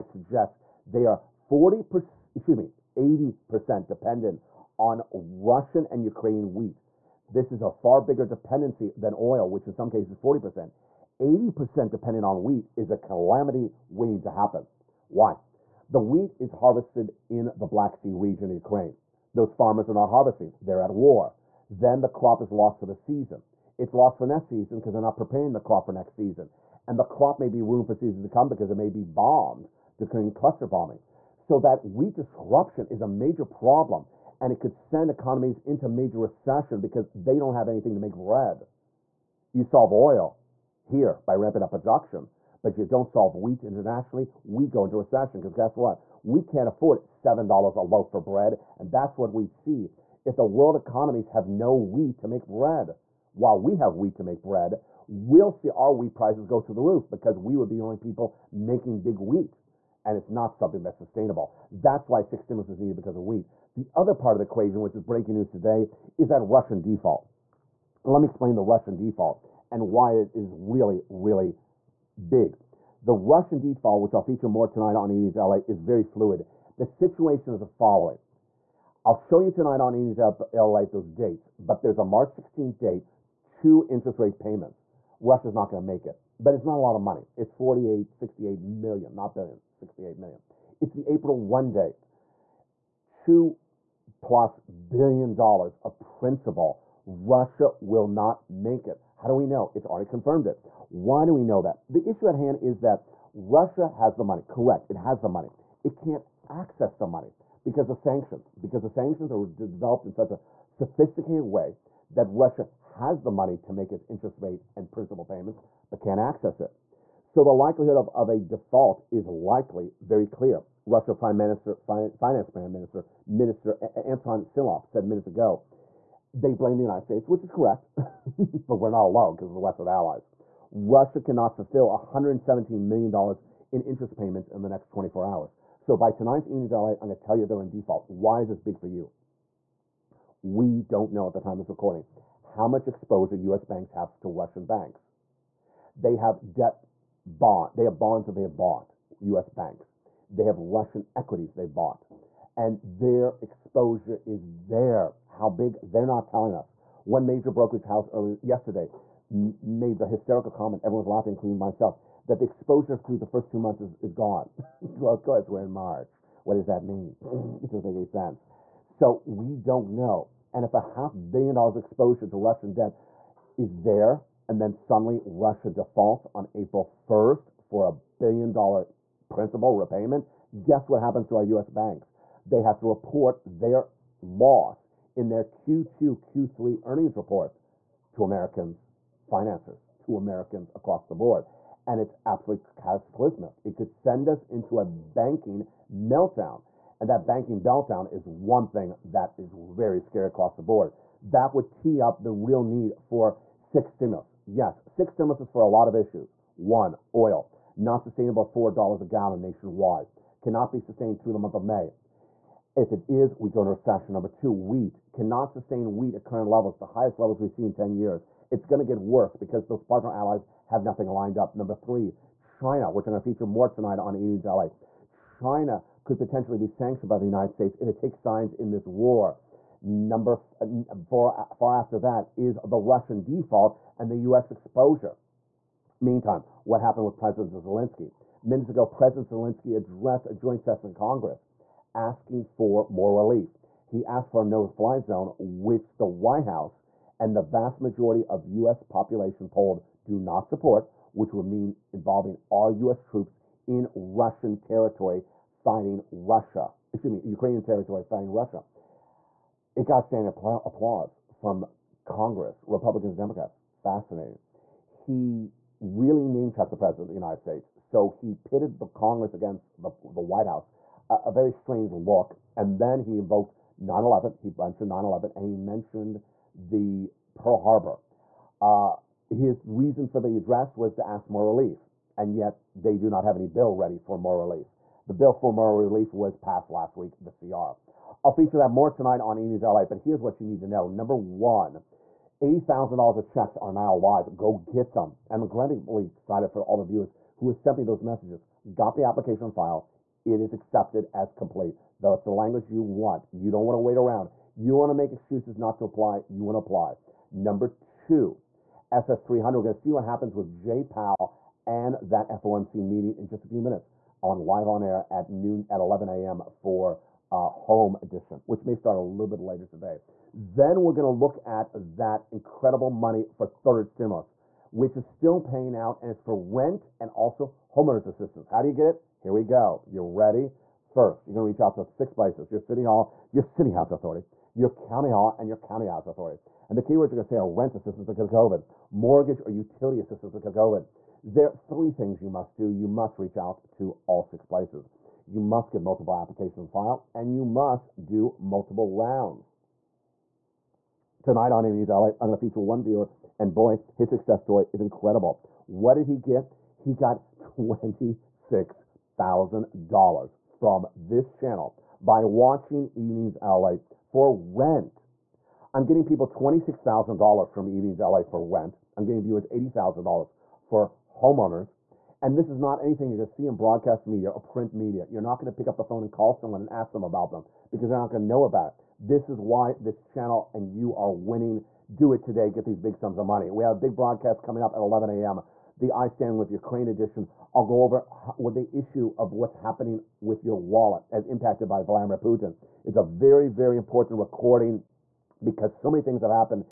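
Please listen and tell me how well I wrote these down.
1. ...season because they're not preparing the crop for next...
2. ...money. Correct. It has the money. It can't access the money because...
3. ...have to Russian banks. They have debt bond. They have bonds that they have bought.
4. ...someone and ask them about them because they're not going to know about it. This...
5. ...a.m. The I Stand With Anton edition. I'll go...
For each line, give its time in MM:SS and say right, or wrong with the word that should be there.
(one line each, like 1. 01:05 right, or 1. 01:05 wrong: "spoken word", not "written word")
1. 00:24 right
2. 01:44 right
3. 02:23 right
4. 06:16 right
5. 06:25 wrong: "Ukraine", not "Anton".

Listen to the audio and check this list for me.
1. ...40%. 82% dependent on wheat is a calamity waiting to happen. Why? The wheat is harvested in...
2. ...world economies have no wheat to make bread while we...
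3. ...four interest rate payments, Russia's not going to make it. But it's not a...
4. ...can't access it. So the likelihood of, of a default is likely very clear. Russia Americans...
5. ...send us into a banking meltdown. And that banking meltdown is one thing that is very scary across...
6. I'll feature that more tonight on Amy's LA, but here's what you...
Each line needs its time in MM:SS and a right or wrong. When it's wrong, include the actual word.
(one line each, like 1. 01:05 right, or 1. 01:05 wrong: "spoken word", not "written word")
1. 00:10 wrong: "80", not "82"
2. 00:50 right
3. 01:23 wrong: "two", not "four"
4. 01:55 wrong: "Prime", not "Americans"
5. 03:13 right
6. 04:48 right.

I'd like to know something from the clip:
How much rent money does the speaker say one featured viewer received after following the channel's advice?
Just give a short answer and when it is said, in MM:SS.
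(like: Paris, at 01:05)
$26,000, at 06:06.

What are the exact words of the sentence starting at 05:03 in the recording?
You don't want to wait around.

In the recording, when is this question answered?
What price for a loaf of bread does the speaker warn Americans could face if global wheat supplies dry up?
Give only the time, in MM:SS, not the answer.
00:47.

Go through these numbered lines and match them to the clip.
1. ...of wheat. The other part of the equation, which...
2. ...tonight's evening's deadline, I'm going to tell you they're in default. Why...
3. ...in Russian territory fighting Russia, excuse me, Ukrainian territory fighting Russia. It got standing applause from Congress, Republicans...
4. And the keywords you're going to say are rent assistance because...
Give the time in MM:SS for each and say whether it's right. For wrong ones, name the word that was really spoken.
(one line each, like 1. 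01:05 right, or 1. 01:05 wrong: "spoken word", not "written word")
1. 01:03 right
2. 02:16 right
3. 04:13 right
4. 05:36 right.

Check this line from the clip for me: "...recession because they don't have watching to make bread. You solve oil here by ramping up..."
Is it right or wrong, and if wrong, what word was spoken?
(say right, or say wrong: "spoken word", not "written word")
wrong: "anything", not "watching".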